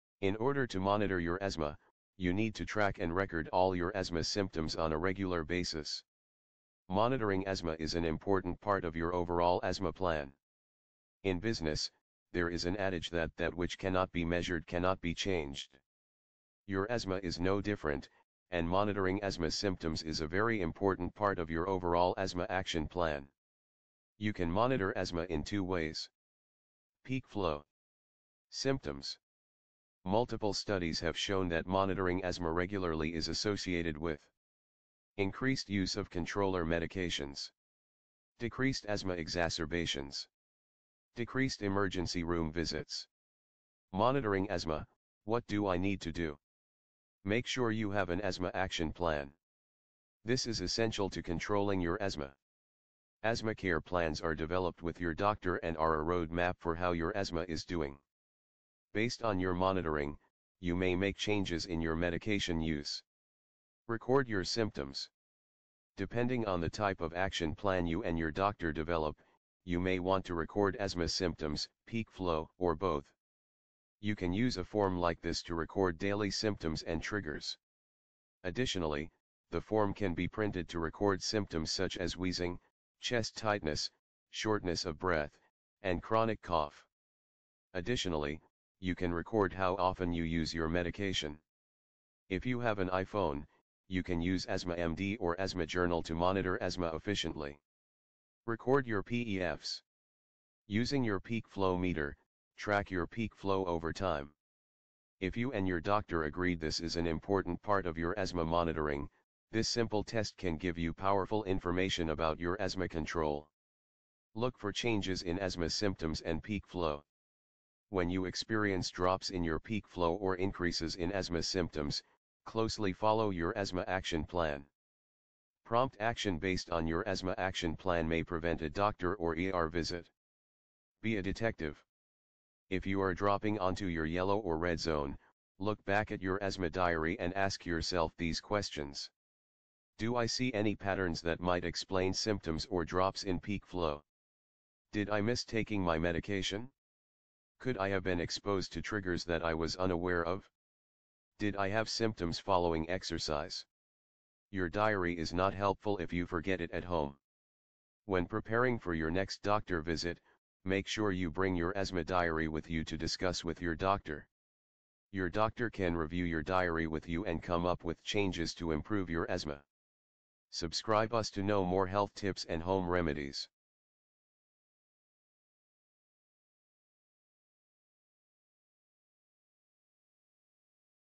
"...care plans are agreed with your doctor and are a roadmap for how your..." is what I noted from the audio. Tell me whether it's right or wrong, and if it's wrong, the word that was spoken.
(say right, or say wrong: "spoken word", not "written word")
wrong: "developed", not "agreed".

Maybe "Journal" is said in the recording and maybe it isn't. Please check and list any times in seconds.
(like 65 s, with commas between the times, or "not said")
95 s.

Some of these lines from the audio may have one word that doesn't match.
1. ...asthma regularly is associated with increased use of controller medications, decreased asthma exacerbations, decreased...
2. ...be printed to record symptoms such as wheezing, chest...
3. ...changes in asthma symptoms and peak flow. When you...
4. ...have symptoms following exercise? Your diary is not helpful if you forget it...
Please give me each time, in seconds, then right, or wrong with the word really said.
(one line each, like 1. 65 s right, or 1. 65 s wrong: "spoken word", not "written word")
1. 32 s right
2. 80 s right
3. 114 s right
4. 151 s right.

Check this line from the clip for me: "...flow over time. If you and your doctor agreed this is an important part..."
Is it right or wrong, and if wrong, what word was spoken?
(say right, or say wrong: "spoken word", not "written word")
right.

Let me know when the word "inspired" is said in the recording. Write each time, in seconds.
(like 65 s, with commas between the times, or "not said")
not said.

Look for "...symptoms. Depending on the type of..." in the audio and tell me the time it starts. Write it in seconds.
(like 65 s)
64 s.